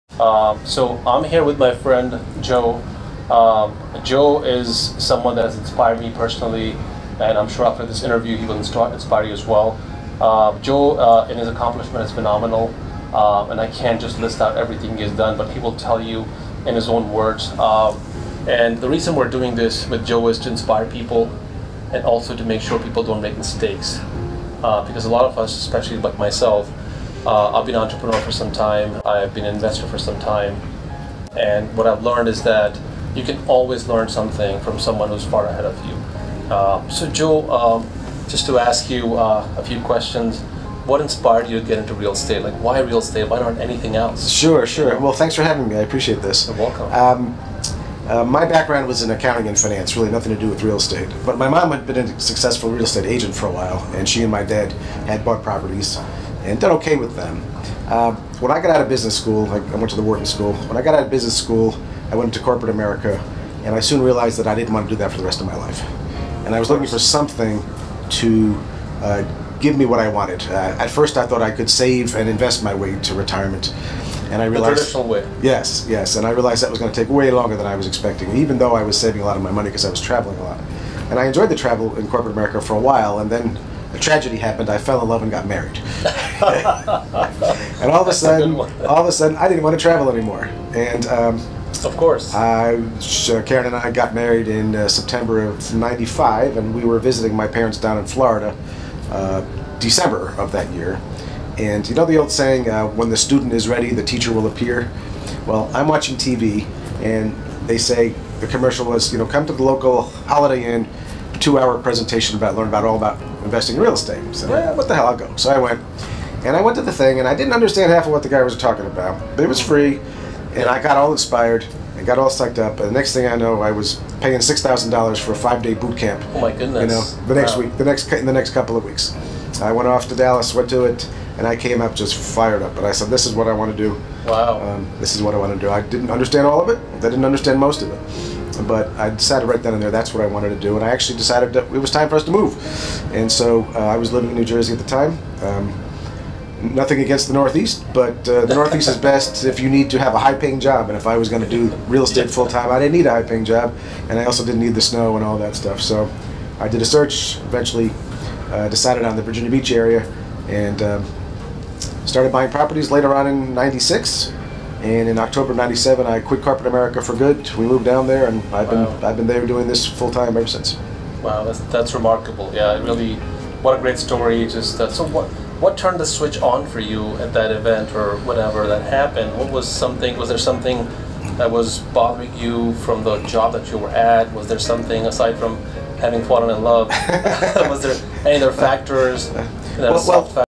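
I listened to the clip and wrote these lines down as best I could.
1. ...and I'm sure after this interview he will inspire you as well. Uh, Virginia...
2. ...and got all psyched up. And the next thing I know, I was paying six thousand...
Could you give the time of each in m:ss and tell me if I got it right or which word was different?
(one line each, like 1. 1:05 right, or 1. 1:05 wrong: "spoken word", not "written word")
1. 0:07 wrong: "Joe", not "Virginia"
2. 2:01 right.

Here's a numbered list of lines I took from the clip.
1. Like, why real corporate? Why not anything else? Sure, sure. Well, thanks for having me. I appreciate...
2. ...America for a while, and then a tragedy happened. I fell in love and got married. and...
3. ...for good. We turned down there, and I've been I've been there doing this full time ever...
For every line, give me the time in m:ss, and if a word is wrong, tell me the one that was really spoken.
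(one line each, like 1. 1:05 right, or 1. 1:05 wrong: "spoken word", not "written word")
1. 0:42 wrong: "estate", not "corporate"
2. 1:22 right
3. 2:47 wrong: "moved", not "turned".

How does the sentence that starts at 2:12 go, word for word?
And I said, "This is what I want to do.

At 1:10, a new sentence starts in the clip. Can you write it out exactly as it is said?
Uh, at first, I thought I could save and invest my way to retirement, and I realized the traditional way.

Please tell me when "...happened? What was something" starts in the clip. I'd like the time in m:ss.
2:58.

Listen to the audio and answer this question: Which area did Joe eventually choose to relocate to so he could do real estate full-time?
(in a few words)
Virginia Beach.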